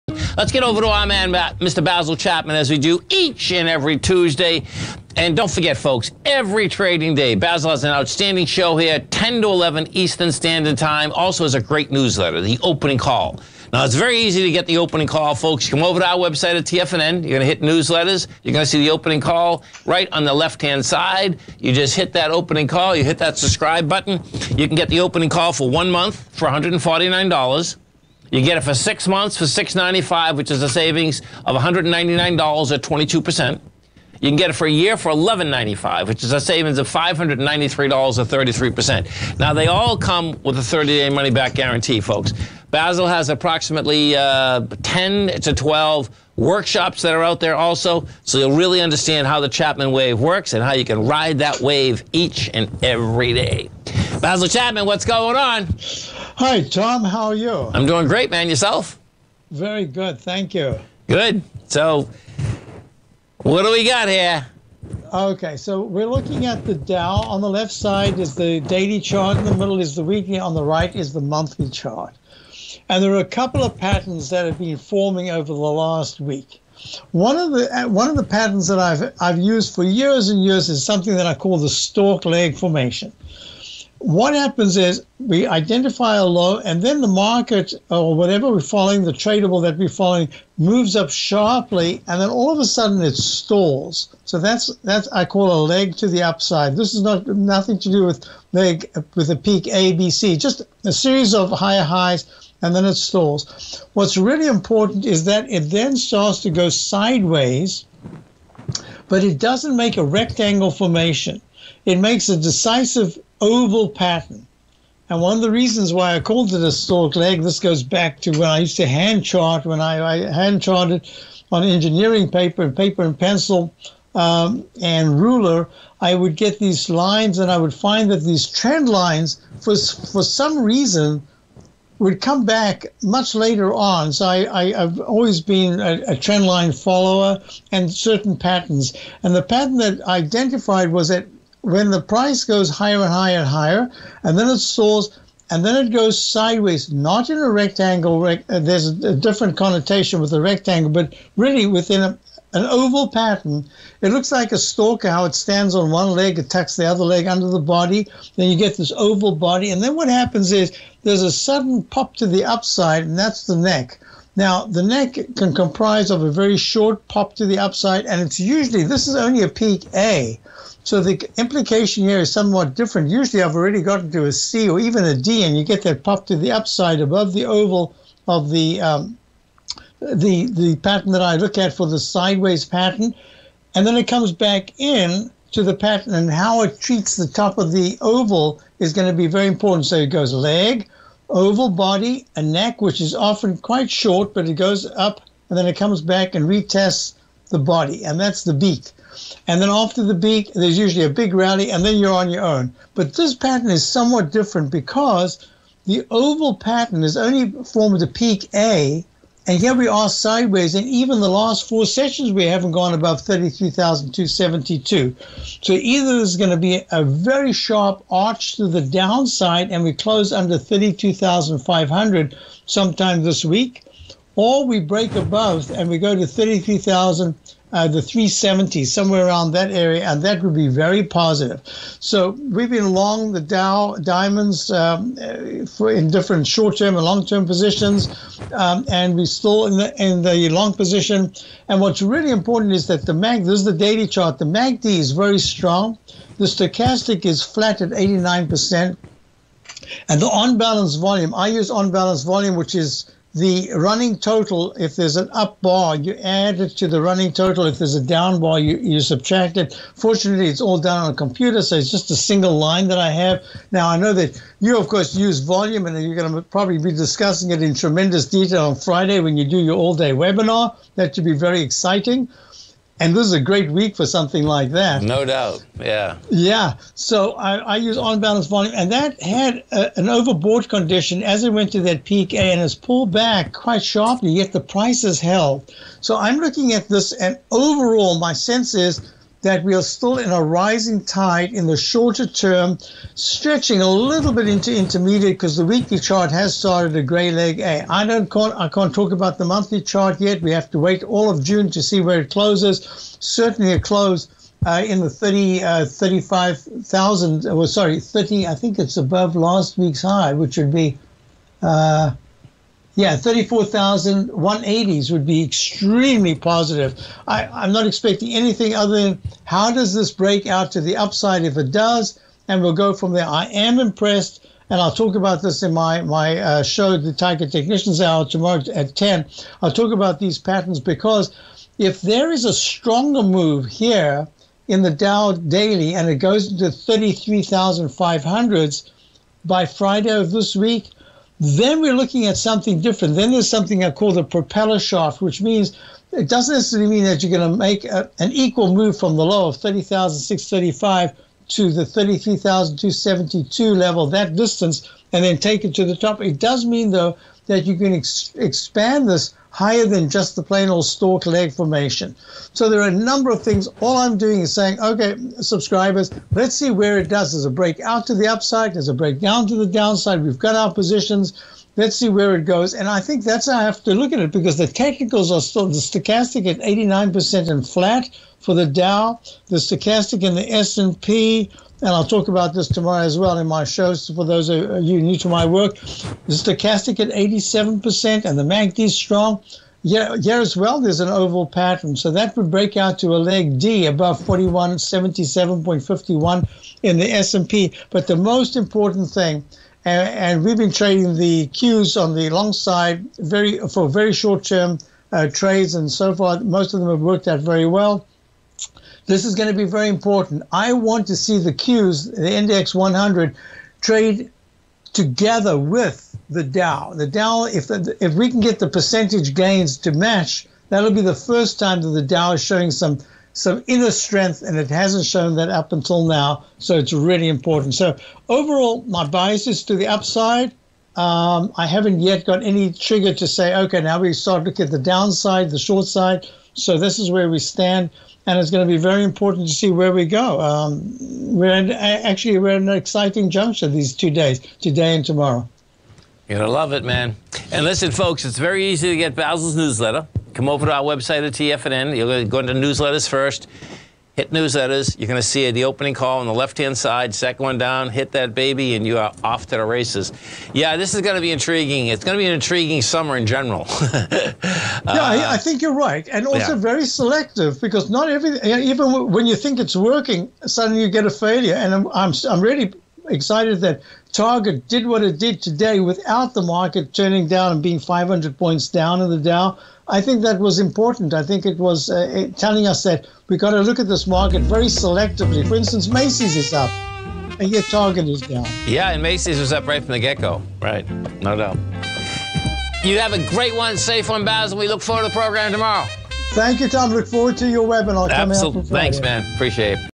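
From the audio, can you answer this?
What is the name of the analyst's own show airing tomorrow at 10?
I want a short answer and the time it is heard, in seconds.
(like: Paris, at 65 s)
Tiger Technicians Hour, at 327 s.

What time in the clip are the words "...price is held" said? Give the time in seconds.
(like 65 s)
284 s.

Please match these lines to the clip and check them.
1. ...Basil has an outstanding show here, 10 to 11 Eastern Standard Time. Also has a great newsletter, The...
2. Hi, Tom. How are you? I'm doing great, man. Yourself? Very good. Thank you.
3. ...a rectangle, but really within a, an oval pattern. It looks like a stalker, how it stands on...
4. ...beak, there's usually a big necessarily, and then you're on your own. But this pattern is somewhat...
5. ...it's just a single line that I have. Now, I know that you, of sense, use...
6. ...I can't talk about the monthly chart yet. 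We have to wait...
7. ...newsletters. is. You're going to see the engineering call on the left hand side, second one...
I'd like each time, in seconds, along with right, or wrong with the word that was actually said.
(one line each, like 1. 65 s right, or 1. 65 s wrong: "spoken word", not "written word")
1. 7 s right
2. 56 s right
3. 150 s right
4. 200 s wrong: "rally", not "necessarily"
5. 261 s wrong: "course", not "sense"
6. 298 s right
7. 454 s wrong: "opening", not "engineering".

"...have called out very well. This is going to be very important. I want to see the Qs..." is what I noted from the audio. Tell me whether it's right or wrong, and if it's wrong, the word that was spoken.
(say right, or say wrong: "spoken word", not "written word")
wrong: "worked", not "called".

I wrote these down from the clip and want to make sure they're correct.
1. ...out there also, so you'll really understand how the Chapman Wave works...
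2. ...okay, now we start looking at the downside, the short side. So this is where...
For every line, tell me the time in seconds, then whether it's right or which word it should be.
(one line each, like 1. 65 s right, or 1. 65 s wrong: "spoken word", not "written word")
1. 47 s right
2. 433 s right.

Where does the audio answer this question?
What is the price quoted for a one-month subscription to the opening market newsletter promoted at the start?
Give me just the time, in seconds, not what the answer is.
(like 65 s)
26 s.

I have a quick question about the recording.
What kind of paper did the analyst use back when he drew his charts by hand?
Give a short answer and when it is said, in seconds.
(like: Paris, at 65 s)
engineering paper, at 121 s.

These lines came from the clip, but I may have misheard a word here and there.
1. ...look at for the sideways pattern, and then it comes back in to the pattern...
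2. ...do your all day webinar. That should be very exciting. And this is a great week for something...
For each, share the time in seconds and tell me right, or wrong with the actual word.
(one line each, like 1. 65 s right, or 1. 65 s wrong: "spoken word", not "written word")
1. 181 s right
2. 269 s right.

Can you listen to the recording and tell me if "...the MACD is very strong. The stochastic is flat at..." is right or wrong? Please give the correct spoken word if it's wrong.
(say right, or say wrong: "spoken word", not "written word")
right.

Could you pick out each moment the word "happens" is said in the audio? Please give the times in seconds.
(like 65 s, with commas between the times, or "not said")
84 s, 160 s.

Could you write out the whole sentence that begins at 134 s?
So I, have always been a, a trend line follower and certain patterns.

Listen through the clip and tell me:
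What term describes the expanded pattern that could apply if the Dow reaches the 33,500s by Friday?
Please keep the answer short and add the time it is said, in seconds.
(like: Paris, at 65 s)
propeller shaft, at 344 s.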